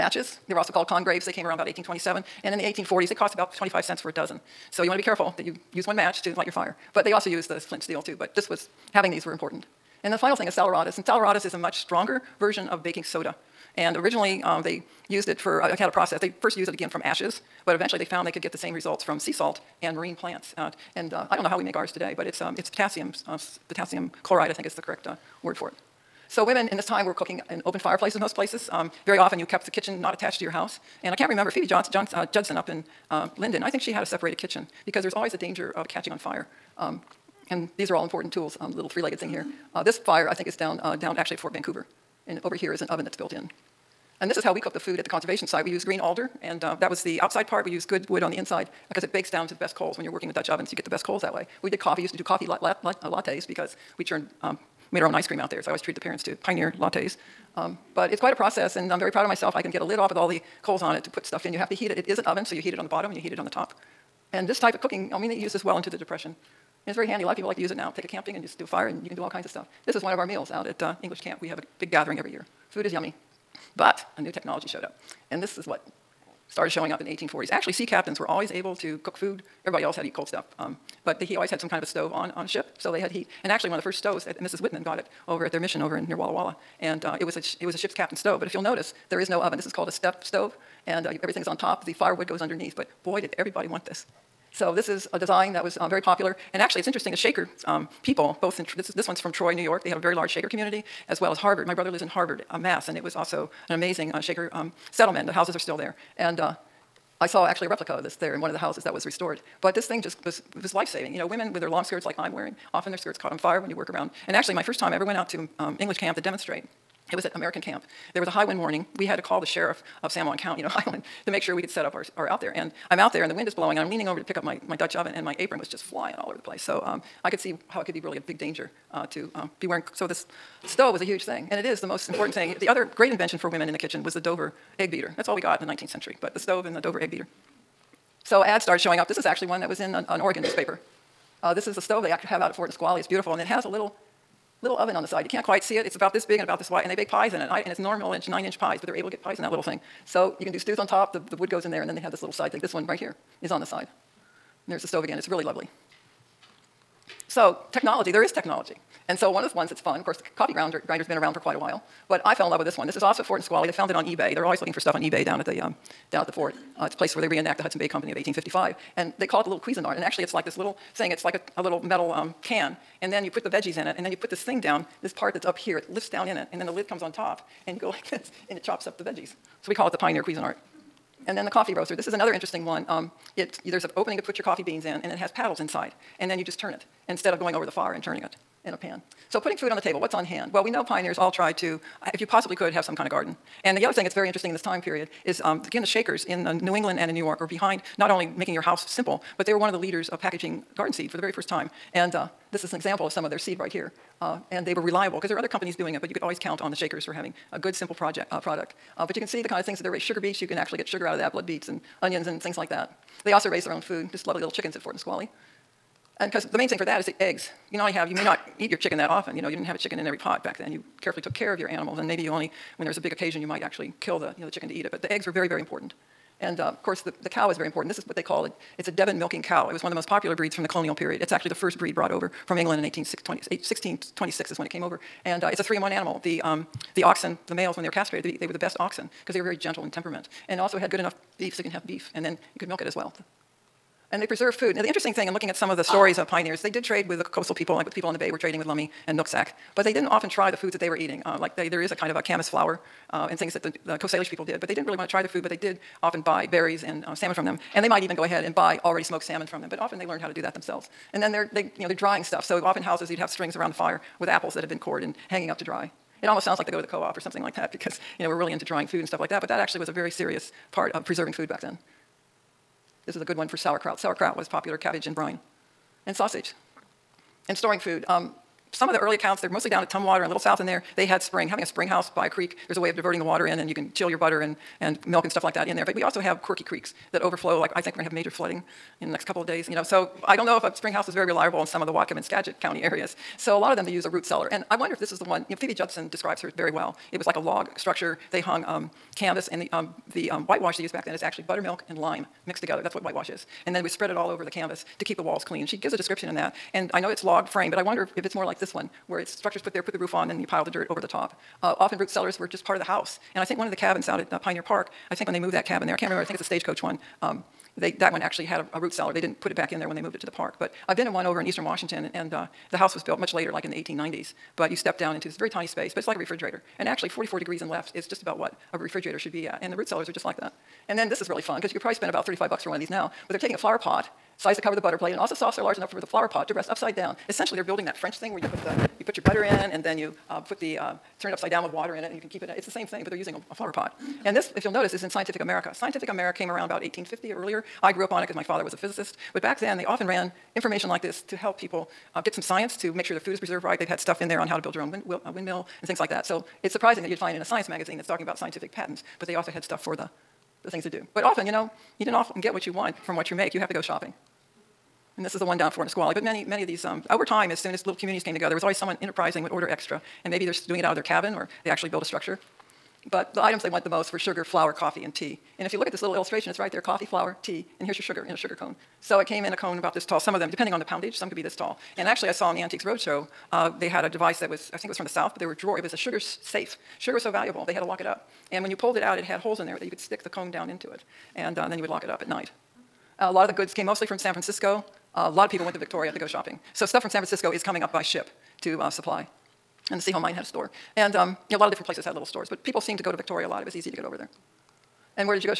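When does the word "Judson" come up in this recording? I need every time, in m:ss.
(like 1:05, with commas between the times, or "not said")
0:32, 4:55.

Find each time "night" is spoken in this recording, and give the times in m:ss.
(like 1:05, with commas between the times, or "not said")
6:32.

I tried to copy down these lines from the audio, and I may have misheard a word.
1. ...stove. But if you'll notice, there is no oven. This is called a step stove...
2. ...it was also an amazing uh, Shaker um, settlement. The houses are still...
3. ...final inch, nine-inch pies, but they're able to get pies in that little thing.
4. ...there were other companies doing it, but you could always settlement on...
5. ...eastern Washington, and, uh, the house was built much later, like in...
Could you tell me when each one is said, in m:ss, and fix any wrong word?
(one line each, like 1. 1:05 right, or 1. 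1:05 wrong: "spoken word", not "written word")
1. 1:28 right
2. 1:42 right
3. 2:27 wrong: "normal", not "final"
4. 3:25 wrong: "count", not "settlement"
5. 5:21 right.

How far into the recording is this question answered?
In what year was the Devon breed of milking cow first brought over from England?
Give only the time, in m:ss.
3:52.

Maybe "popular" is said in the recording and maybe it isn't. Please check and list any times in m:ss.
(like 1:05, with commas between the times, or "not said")
1:36, 3:50, 4:34.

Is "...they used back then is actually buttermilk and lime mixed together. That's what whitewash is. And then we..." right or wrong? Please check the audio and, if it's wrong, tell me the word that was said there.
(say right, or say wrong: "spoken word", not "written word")
right.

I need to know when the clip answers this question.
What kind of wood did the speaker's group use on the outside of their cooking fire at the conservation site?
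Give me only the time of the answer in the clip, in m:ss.
0:45.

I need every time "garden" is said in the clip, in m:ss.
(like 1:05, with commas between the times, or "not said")
3:13, 3:20.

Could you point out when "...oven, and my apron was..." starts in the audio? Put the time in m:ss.
2:04.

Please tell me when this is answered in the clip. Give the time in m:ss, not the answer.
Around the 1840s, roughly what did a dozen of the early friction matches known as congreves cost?
0:03.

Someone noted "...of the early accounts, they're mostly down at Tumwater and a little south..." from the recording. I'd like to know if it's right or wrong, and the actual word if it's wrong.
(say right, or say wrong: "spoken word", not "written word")
right.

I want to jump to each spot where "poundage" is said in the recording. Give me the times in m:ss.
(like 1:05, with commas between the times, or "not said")
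6:20.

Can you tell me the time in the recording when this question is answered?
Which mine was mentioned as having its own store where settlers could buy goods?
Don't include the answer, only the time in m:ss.
6:40.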